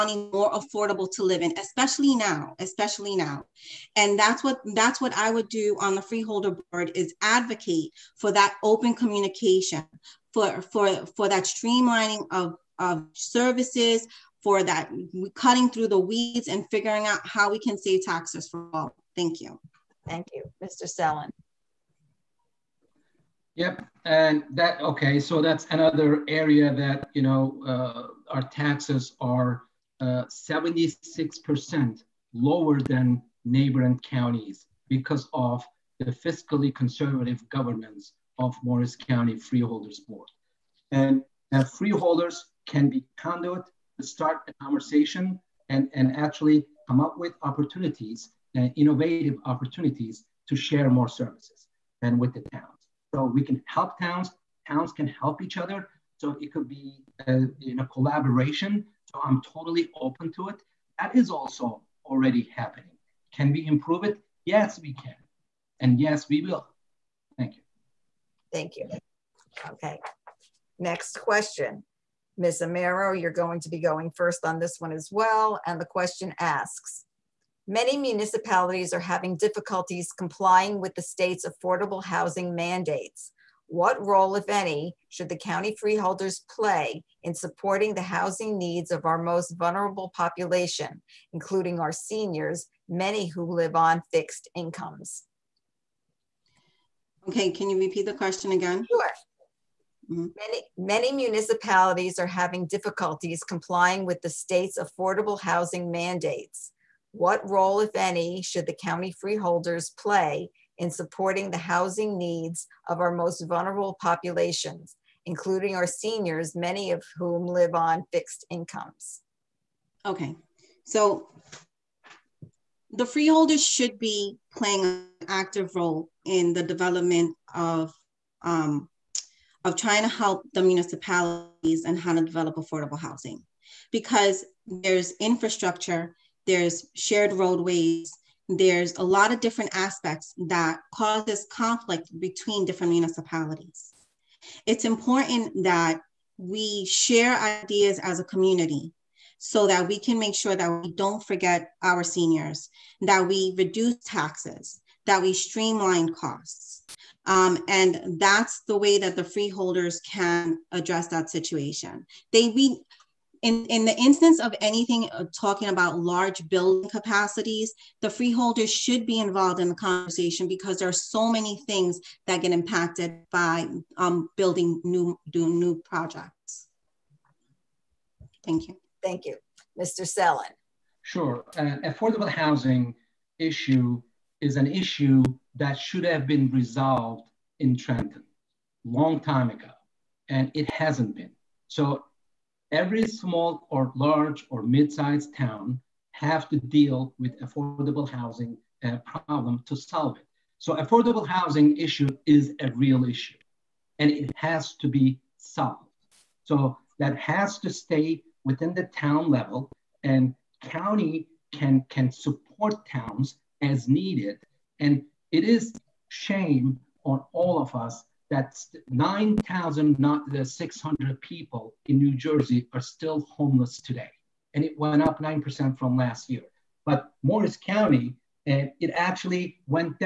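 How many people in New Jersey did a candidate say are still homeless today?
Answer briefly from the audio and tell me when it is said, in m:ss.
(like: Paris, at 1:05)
9,600, at 3:38.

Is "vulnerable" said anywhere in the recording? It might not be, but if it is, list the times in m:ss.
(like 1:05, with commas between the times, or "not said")
1:29, 1:53.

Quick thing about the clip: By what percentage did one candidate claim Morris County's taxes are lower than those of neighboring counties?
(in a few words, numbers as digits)
76%.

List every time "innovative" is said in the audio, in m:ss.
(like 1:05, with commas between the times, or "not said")
0:48.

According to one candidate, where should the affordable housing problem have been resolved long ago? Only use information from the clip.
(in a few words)
Trenton.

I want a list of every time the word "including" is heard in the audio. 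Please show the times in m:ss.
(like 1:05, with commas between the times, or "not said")
1:31, 1:55.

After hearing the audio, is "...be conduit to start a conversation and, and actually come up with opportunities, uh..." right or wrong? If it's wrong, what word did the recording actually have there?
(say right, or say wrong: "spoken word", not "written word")
right.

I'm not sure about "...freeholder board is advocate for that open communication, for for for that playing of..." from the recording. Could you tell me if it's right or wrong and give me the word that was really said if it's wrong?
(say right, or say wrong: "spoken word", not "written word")
wrong: "streamlining", not "playing".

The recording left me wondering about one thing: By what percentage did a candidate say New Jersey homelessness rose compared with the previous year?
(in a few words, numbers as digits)
9%.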